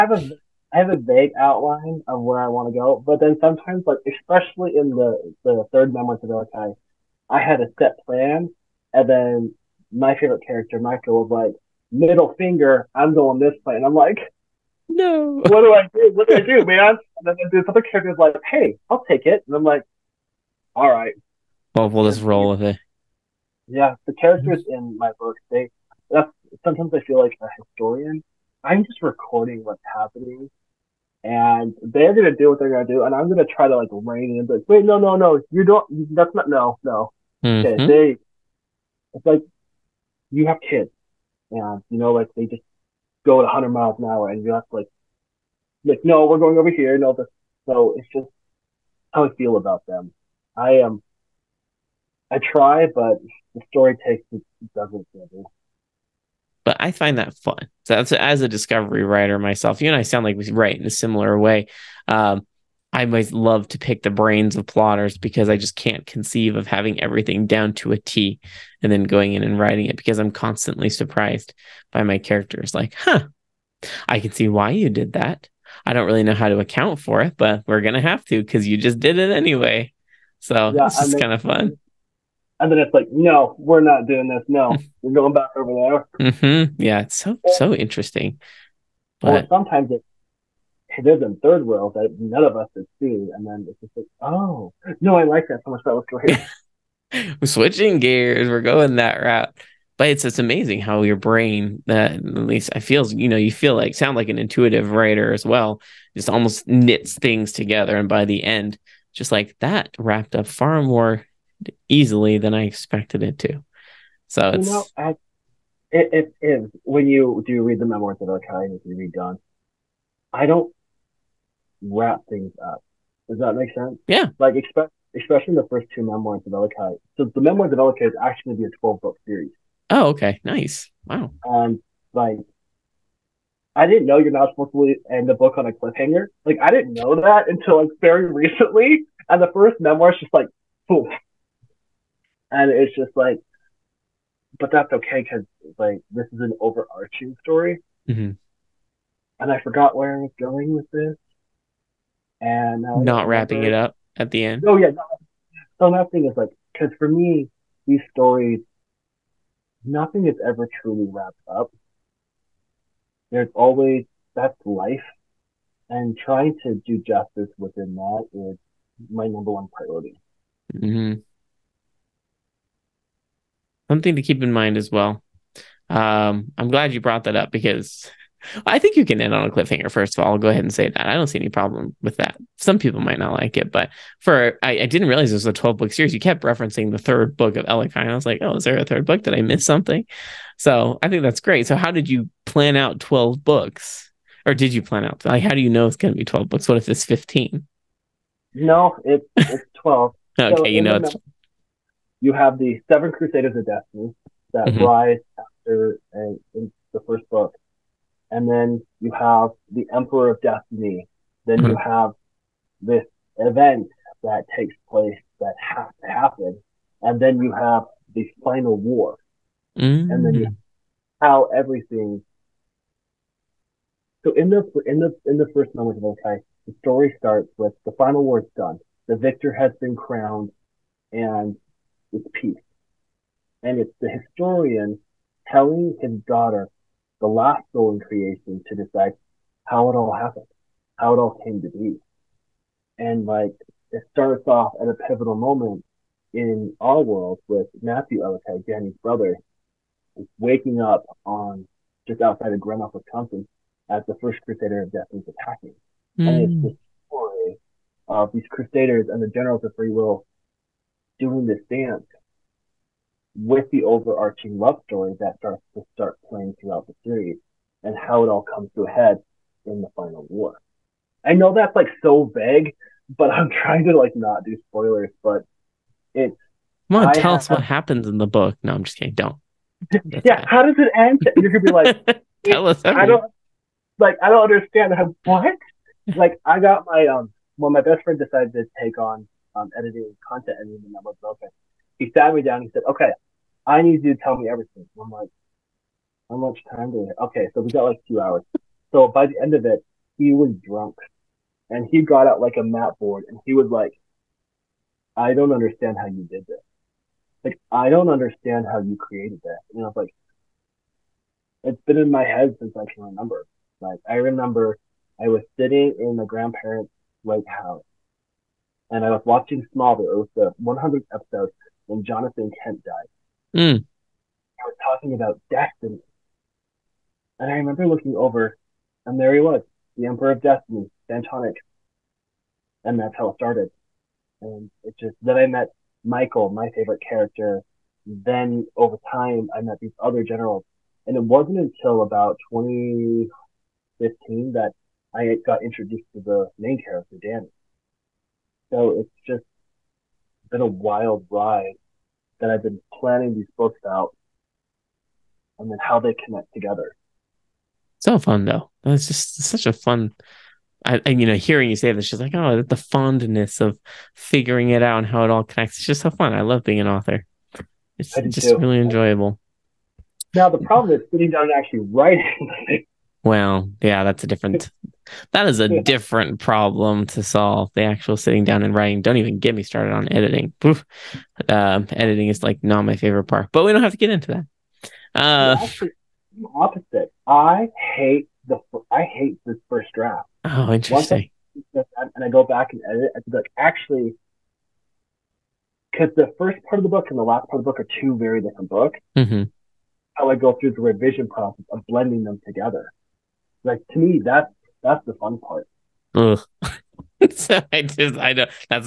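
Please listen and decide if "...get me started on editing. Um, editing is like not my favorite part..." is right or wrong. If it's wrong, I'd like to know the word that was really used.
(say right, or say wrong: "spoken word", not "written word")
right.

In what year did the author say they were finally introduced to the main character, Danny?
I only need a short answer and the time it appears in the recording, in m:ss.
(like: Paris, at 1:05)
2015, at 5:42.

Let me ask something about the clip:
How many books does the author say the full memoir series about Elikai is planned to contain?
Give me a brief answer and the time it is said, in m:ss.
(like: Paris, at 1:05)
12, at 2:08.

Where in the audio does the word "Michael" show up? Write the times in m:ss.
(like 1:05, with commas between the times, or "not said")
0:10, 5:36.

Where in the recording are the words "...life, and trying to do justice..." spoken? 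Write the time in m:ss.
2:44.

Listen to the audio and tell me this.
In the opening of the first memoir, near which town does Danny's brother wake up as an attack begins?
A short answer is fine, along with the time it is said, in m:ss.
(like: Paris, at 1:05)
Grand Rapids, Wisconsin, at 4:12.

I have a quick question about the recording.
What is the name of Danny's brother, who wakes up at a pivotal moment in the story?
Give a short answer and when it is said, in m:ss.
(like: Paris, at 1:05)
Matthew Ellicott, at 4:07.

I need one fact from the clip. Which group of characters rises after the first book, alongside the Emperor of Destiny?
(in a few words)
Seven Crusaders of Destiny.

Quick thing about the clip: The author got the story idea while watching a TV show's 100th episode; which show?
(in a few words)
Smallville.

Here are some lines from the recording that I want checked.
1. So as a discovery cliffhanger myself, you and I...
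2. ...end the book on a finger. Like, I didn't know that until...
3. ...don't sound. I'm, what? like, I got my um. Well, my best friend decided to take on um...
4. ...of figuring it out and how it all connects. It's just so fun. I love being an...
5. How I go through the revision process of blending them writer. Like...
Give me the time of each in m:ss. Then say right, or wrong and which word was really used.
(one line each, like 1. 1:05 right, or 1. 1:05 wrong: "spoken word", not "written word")
1. 0:57 wrong: "writer", not "cliffhanger"
2. 2:15 wrong: "cliffhanger", not "finger"
3. 4:44 wrong: "understand", not "sound"
4. 6:03 right
5. 6:40 wrong: "together", not "writer".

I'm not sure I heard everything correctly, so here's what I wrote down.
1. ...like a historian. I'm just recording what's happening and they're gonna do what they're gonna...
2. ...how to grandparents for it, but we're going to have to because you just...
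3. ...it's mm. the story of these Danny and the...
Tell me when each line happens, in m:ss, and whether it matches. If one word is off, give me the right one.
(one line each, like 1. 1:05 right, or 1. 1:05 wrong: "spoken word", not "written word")
1. 0:27 right
2. 1:16 wrong: "account", not "grandparents"
3. 4:16 wrong: "Crusaders", not "Danny".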